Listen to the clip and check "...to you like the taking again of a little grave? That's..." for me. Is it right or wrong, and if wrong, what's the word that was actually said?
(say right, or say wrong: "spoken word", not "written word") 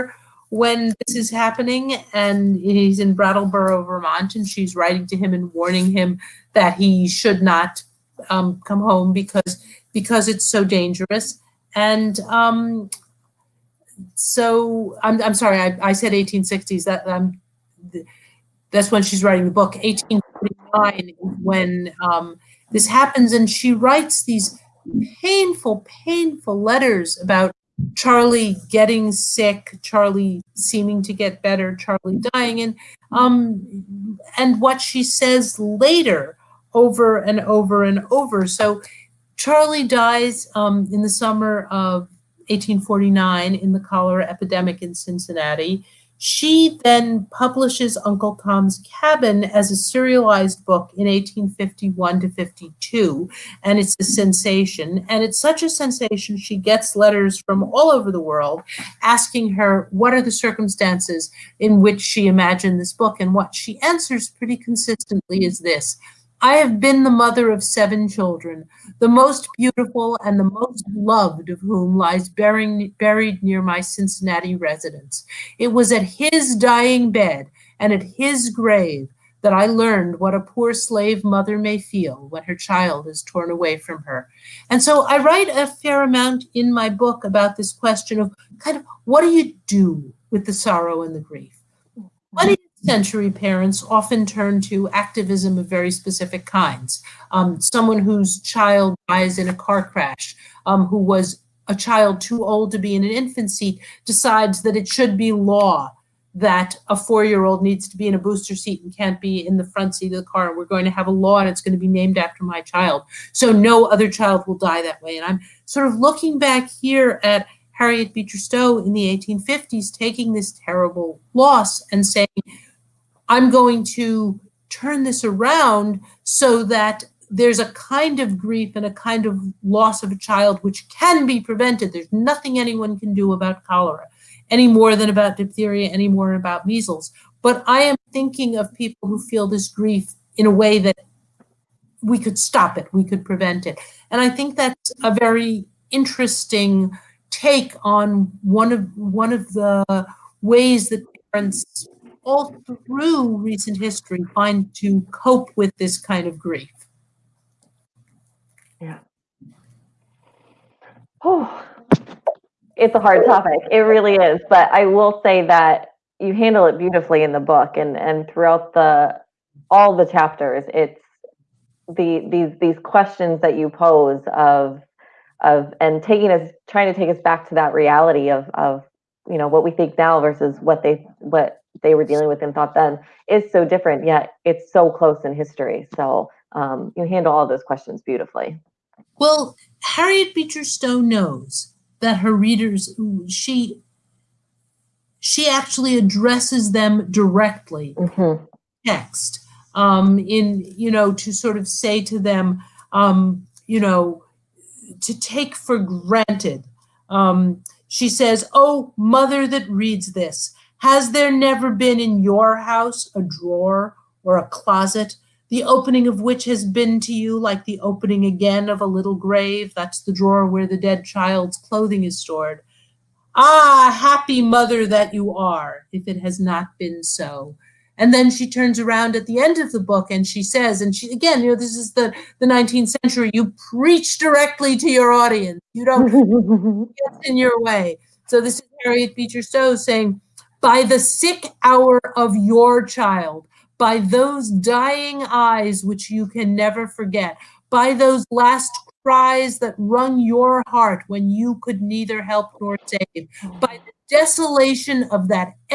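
wrong: "opening", not "taking".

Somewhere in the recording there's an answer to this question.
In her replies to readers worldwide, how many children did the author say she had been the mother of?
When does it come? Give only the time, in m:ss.
1:07.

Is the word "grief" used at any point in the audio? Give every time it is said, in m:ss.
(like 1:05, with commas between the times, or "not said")
1:31, 2:08, 2:19, 2:36.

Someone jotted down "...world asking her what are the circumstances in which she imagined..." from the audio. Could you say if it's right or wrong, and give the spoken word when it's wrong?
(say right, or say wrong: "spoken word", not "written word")
right.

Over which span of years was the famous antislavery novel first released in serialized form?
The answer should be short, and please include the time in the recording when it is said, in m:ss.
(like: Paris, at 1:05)
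1851 to 1852, at 0:51.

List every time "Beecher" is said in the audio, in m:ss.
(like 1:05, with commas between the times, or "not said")
1:58, 3:10, 3:59.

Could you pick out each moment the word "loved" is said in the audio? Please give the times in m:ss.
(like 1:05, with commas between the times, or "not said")
1:10.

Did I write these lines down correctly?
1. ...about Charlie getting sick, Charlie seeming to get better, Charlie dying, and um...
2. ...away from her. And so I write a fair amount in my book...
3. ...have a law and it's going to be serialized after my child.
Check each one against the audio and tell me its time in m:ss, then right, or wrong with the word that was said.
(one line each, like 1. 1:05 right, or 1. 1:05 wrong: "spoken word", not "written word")
1. 0:27 right
2. 1:23 right
3. 1:50 wrong: "named", not "serialized".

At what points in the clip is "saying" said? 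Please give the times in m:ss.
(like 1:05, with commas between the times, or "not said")
2:02, 3:59.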